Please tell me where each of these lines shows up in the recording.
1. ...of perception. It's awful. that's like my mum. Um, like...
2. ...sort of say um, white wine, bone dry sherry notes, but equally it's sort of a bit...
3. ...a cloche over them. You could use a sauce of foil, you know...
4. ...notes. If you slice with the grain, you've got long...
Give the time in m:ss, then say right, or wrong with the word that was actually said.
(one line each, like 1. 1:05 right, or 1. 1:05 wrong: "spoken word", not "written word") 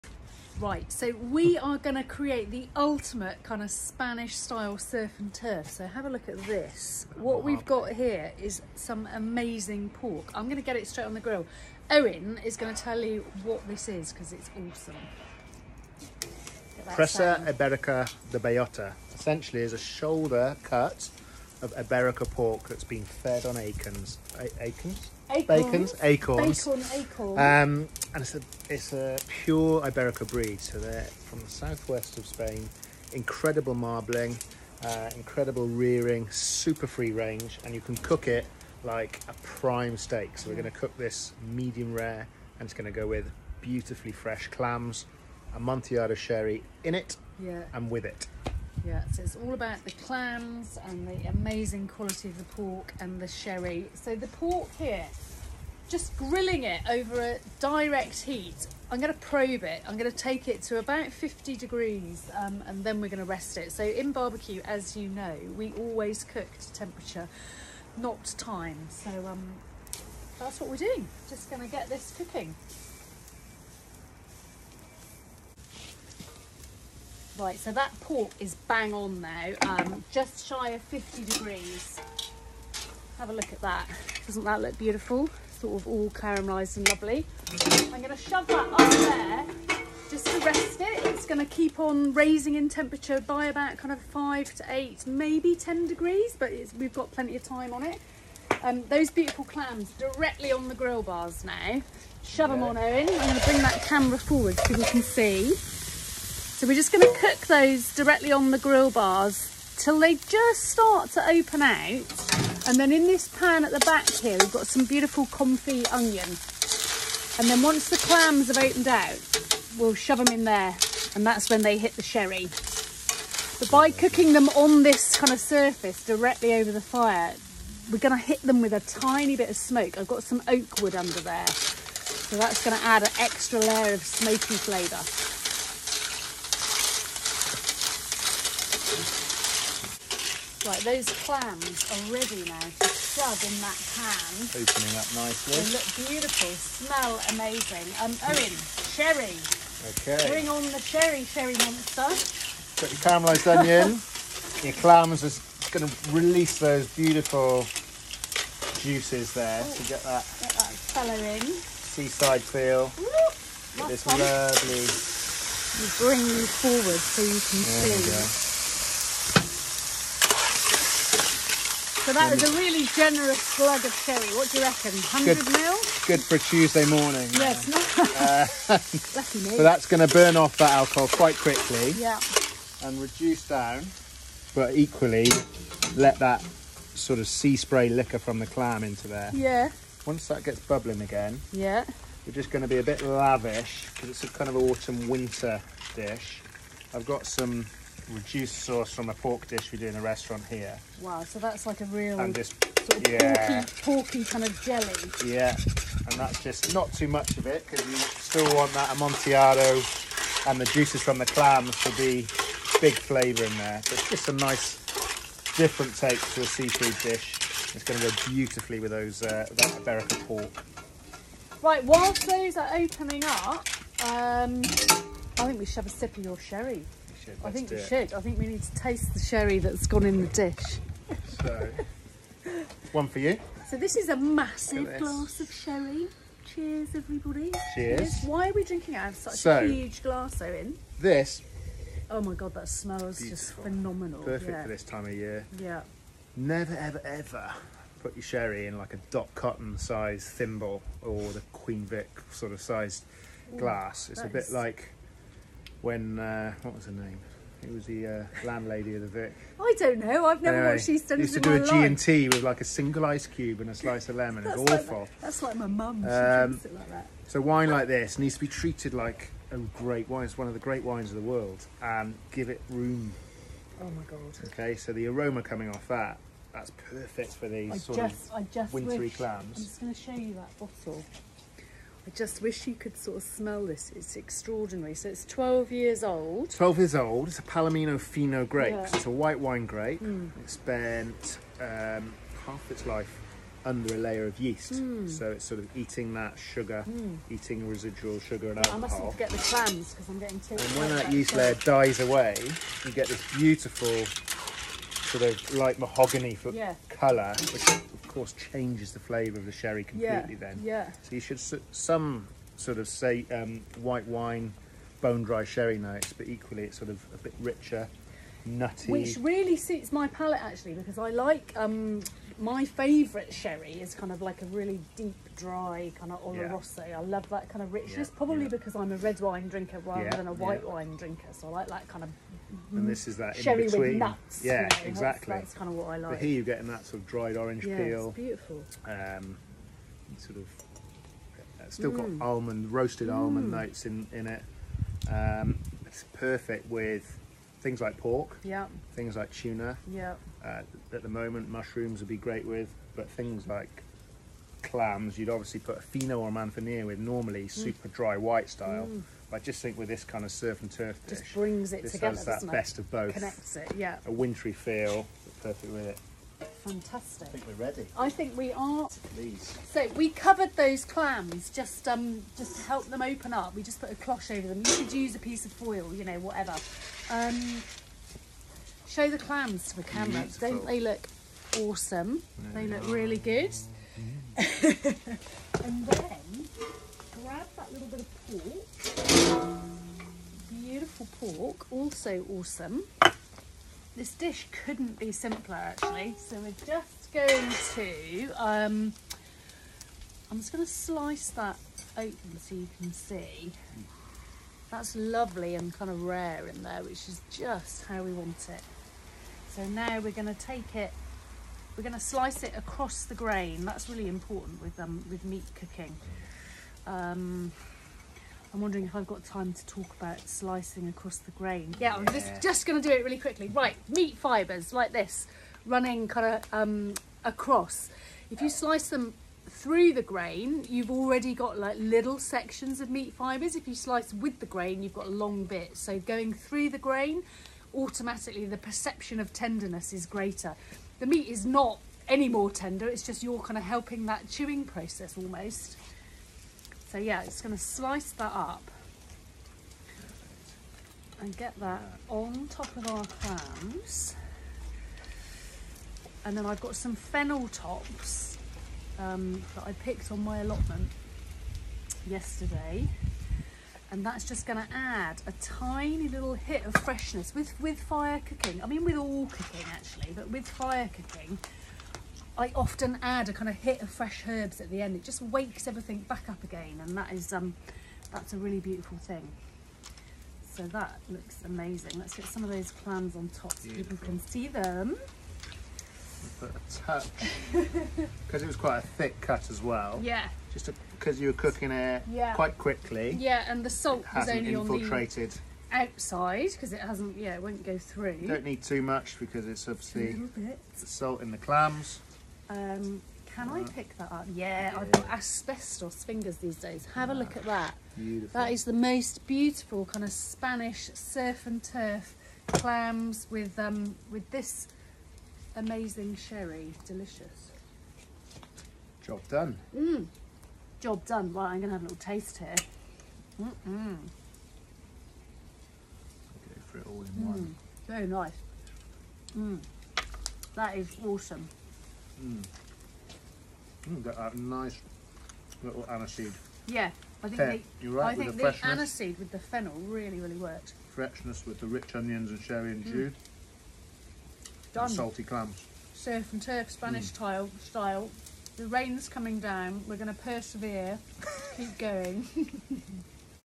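1. 4:24 wrong: "lemon", not "perception"
2. 5:12 right
3. 6:13 wrong: "piece", not "sauce"
4. 7:13 wrong: "fibres", not "notes".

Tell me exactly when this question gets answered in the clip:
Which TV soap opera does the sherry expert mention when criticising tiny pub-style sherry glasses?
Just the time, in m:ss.
4:20.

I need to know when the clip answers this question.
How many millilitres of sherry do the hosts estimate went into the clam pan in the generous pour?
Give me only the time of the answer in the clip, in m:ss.
2:54.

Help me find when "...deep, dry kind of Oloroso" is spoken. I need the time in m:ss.
5:24.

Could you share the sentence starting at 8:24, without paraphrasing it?
Yeah, yeah, I've got asbestos fingers these days.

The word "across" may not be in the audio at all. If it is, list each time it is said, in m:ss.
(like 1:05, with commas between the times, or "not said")
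6:52, 7:00, 7:07.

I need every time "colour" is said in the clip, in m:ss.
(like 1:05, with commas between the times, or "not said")
2:40, 5:06.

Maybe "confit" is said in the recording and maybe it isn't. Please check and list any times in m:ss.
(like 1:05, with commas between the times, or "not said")
1:55.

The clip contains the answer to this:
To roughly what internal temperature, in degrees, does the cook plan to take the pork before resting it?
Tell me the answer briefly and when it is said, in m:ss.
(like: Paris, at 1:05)
50, at 1:00.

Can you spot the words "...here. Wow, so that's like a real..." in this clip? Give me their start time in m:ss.
3:20.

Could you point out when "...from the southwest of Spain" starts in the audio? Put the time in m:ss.
0:31.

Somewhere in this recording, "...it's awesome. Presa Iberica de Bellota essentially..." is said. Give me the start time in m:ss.
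0:14.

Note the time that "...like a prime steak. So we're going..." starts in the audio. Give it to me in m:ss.
0:38.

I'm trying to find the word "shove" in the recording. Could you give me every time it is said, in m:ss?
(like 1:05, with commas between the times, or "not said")
1:28, 1:42, 1:59, 2:22.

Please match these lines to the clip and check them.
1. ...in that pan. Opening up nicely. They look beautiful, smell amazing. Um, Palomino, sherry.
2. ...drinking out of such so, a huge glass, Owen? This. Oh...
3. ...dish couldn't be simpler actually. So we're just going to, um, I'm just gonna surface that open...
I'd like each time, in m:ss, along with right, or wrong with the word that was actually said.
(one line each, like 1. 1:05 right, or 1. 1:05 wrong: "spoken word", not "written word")
1. 2:23 wrong: "Owen", not "Palomino"
2. 3:58 right
3. 6:34 wrong: "slice", not "surface".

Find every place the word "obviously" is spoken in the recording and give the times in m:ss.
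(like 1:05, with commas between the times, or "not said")
5:55, 8:19.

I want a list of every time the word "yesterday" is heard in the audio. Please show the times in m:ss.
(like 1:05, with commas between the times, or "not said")
7:42.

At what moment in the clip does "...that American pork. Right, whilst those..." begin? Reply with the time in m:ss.
3:39.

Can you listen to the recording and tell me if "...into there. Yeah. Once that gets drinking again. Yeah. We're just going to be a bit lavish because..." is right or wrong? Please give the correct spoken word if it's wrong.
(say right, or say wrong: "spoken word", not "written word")
wrong: "bubbling", not "drinking".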